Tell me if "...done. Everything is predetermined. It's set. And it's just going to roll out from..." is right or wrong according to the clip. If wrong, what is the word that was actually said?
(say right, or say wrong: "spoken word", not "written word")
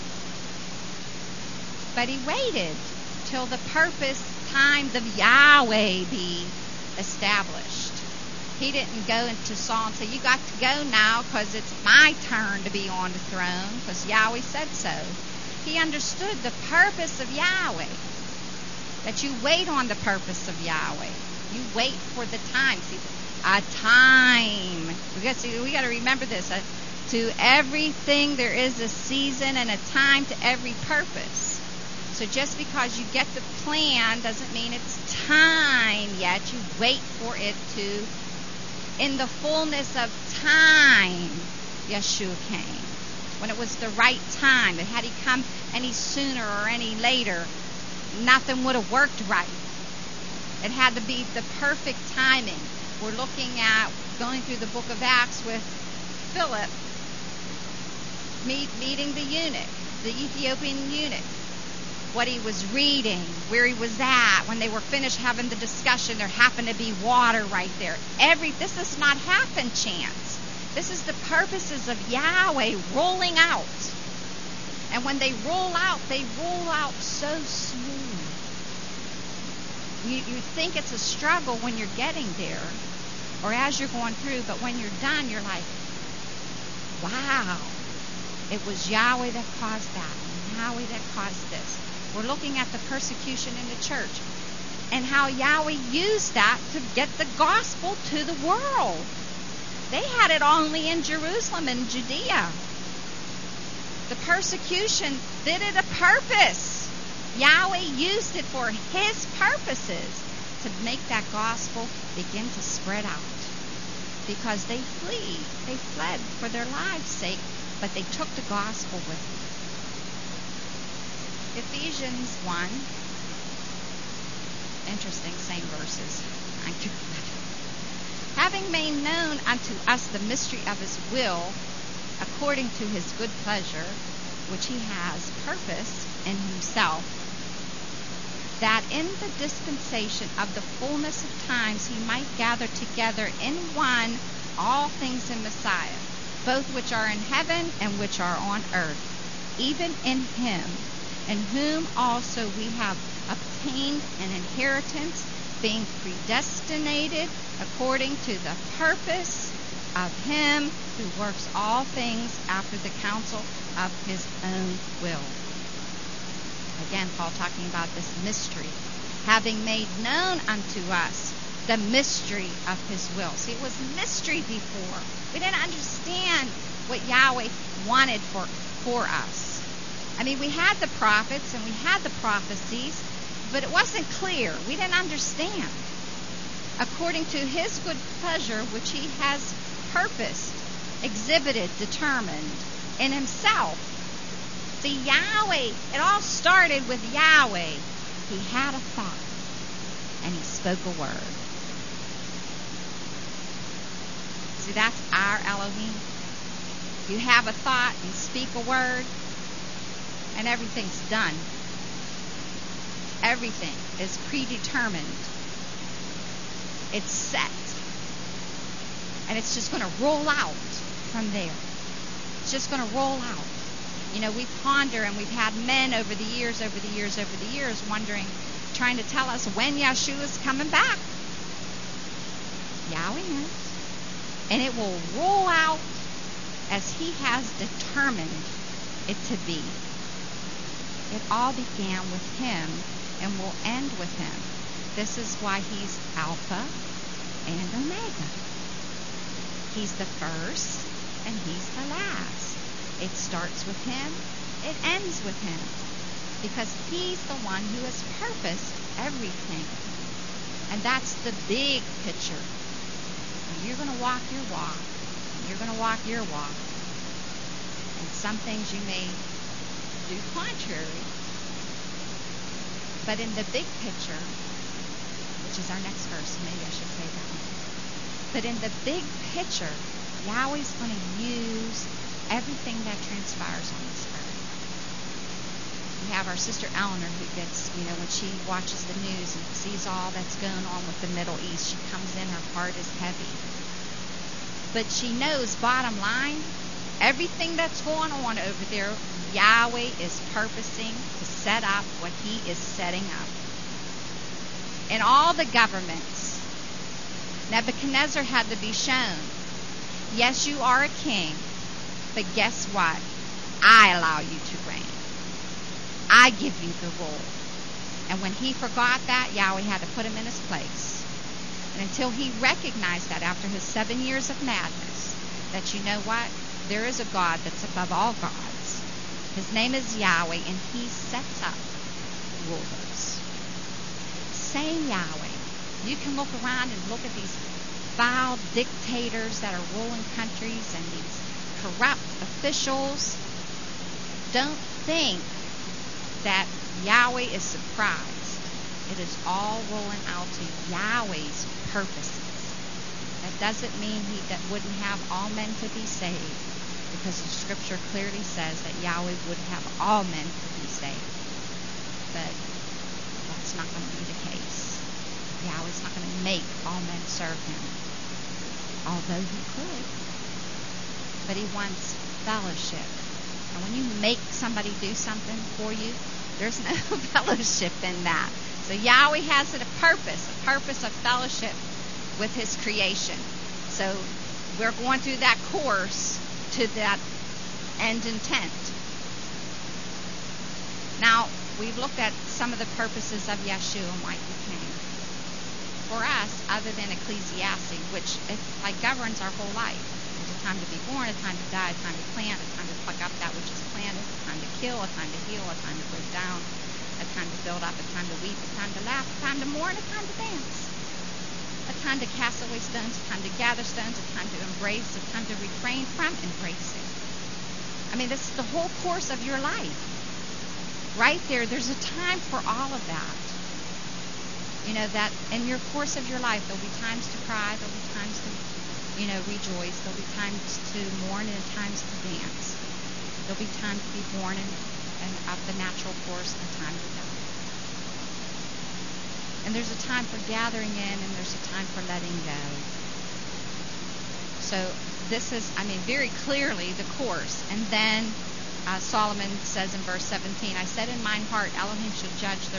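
right.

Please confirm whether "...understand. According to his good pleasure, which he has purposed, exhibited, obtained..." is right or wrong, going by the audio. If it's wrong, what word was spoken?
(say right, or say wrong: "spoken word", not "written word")
wrong: "determined", not "obtained".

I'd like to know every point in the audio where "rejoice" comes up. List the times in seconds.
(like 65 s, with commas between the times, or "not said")
429 s.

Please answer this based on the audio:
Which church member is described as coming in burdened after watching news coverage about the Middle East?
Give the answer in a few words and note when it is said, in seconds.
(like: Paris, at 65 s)
Eleanor, at 286 s.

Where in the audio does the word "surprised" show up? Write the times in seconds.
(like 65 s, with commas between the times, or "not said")
347 s.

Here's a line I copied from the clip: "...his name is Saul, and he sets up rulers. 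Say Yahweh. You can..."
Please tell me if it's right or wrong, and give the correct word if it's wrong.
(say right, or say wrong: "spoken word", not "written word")
wrong: "Yahweh", not "Saul".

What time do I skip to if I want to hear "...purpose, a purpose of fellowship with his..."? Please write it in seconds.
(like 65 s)
379 s.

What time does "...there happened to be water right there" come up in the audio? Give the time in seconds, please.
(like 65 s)
66 s.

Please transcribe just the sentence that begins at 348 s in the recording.
It is all rolling out to Yahweh's purposes.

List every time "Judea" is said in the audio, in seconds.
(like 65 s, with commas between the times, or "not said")
101 s.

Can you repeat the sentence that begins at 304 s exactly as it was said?
And all the governments, Nebuchadnezzar had to be shown.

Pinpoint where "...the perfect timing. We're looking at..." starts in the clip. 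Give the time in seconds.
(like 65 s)
51 s.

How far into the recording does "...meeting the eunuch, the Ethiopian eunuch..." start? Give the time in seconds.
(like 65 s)
58 s.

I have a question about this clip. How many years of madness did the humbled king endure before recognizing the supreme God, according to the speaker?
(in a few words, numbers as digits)
7.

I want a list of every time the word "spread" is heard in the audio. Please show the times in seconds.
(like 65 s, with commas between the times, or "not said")
112 s.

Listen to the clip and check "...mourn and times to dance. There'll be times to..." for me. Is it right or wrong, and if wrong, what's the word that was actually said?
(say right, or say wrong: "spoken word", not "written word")
right.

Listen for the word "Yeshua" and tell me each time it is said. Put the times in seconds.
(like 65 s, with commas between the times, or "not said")
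41 s, 393 s.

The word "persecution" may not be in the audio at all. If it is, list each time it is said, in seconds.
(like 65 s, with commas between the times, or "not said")
92 s, 104 s.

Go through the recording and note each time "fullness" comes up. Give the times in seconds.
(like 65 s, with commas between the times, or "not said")
39 s, 140 s.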